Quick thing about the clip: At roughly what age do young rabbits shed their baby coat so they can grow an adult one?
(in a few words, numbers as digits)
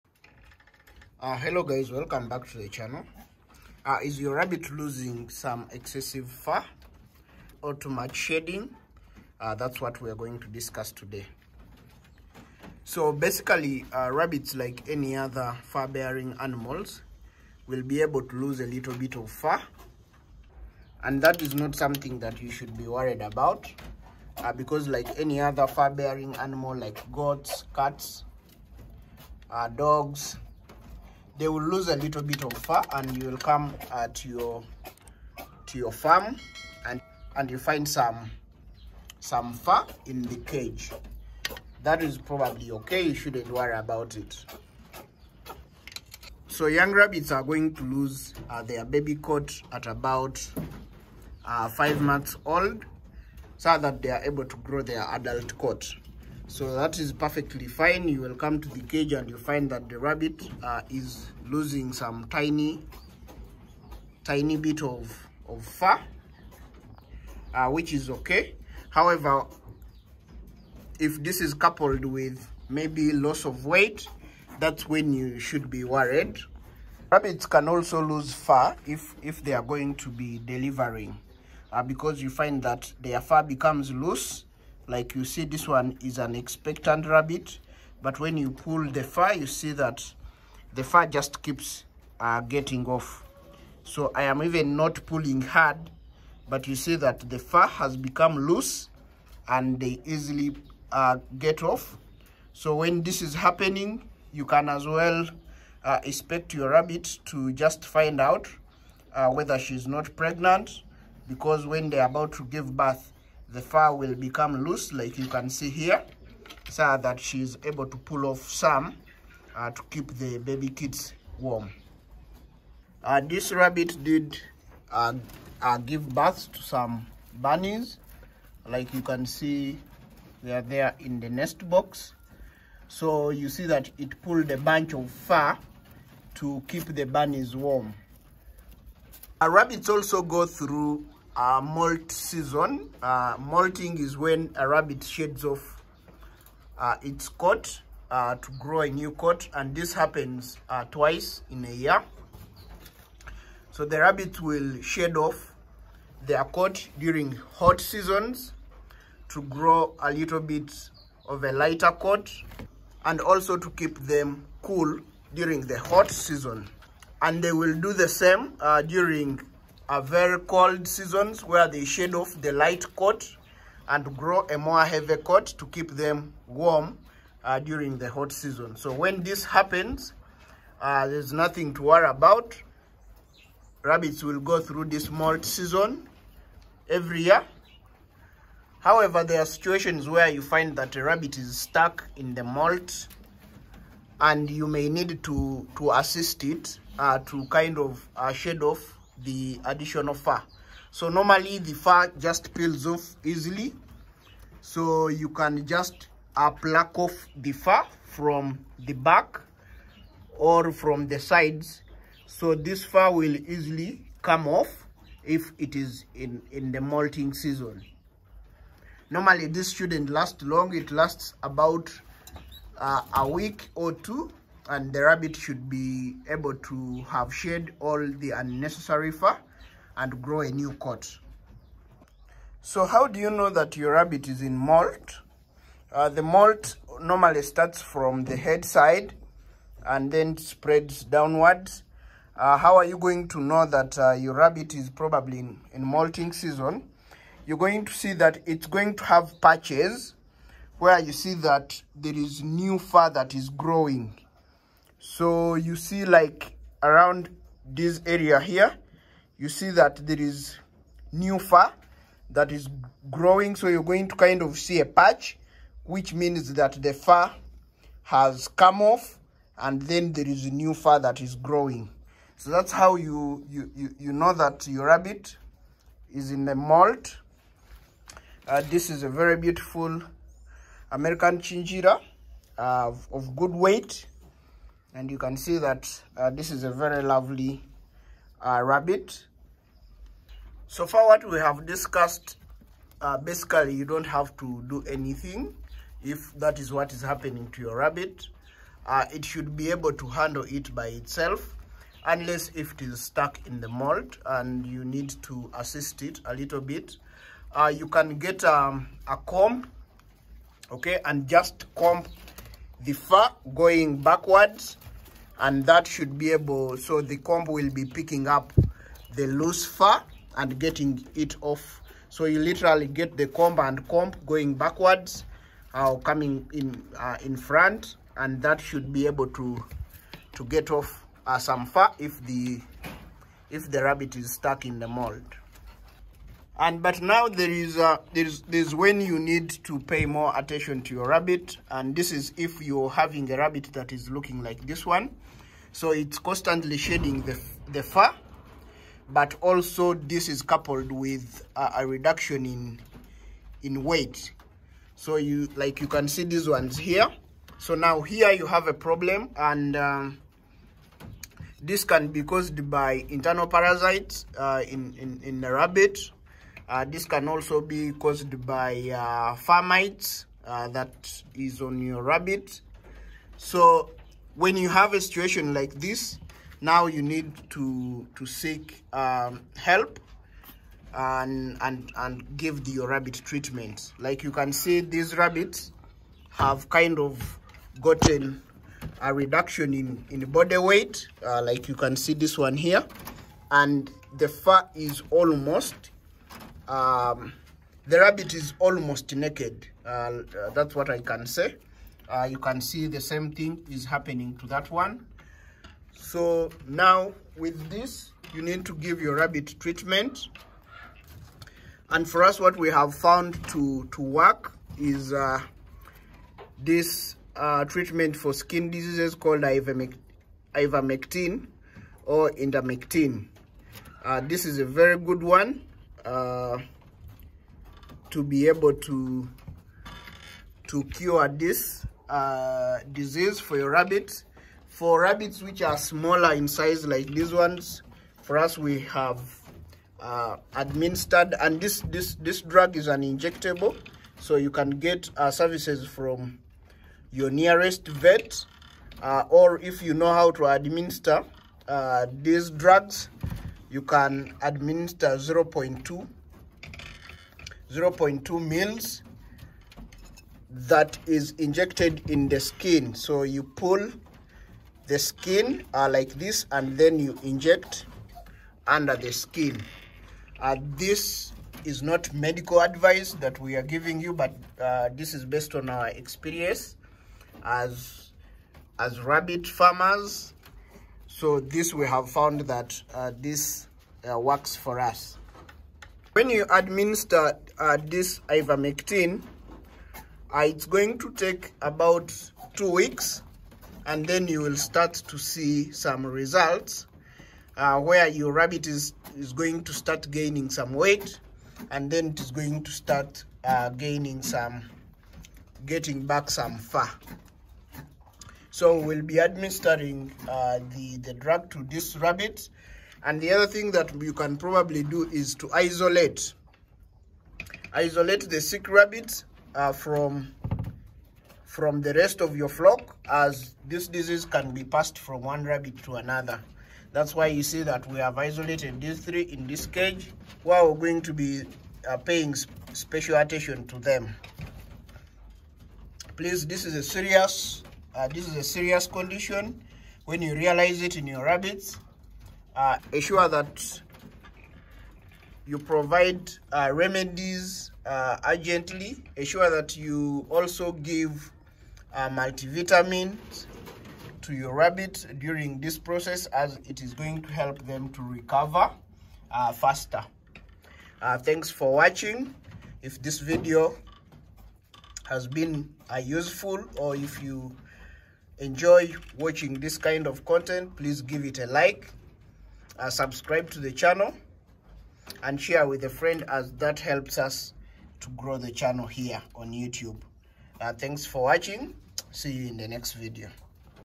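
5 months.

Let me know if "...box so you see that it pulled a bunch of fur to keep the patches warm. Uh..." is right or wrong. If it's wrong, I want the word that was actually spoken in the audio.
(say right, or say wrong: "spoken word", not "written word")
wrong: "bunnies", not "patches".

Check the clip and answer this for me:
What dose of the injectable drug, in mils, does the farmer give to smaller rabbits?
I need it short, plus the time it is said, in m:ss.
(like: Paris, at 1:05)
0.2 mils, at 7:37.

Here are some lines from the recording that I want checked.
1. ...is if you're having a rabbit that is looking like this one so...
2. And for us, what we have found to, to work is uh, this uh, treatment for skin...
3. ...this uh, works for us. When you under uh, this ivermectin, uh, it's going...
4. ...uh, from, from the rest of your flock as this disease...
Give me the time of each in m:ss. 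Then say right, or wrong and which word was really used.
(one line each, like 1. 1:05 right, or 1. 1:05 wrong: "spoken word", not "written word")
1. 5:42 right
2. 6:51 right
3. 8:03 wrong: "administer", not "under"
4. 8:39 right.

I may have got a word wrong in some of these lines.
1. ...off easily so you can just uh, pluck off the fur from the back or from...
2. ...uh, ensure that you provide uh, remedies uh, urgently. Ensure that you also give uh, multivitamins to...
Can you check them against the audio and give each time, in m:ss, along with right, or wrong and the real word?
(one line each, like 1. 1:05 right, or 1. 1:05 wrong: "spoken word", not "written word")
1. 3:22 right
2. 9:02 right.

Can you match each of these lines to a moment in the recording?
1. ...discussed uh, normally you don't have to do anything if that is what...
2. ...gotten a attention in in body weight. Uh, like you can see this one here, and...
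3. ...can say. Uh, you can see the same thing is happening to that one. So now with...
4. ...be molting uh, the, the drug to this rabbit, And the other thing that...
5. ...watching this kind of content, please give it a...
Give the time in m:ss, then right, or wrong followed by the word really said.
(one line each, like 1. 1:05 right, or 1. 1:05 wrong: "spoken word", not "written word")
1. 4:51 wrong: "basically", not "normally"
2. 6:27 wrong: "reduction", not "attention"
3. 6:40 right
4. 8:29 wrong: "administering", not "molting"
5. 9:29 right.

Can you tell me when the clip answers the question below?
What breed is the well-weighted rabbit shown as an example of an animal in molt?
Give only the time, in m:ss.
4:40.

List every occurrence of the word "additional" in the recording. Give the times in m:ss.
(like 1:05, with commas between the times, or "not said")
3:19.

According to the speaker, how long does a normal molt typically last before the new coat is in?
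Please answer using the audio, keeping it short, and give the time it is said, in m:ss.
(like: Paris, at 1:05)
a week or two, at 3:43.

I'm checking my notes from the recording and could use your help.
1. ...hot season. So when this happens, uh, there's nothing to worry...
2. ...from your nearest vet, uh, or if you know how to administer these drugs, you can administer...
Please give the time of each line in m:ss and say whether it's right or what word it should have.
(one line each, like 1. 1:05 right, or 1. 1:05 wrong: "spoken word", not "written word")
1. 2:58 right
2. 7:25 right.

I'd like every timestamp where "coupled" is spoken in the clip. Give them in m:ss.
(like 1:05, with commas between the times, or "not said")
1:11, 5:50.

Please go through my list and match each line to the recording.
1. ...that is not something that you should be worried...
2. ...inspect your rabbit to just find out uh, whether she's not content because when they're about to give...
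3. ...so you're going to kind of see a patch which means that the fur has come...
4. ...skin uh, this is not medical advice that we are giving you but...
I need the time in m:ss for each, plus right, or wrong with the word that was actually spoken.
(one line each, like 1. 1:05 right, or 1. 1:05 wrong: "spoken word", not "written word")
1. 0:21 right
2. 1:46 wrong: "pregnant", not "content"
3. 4:23 right
4. 7:49 right.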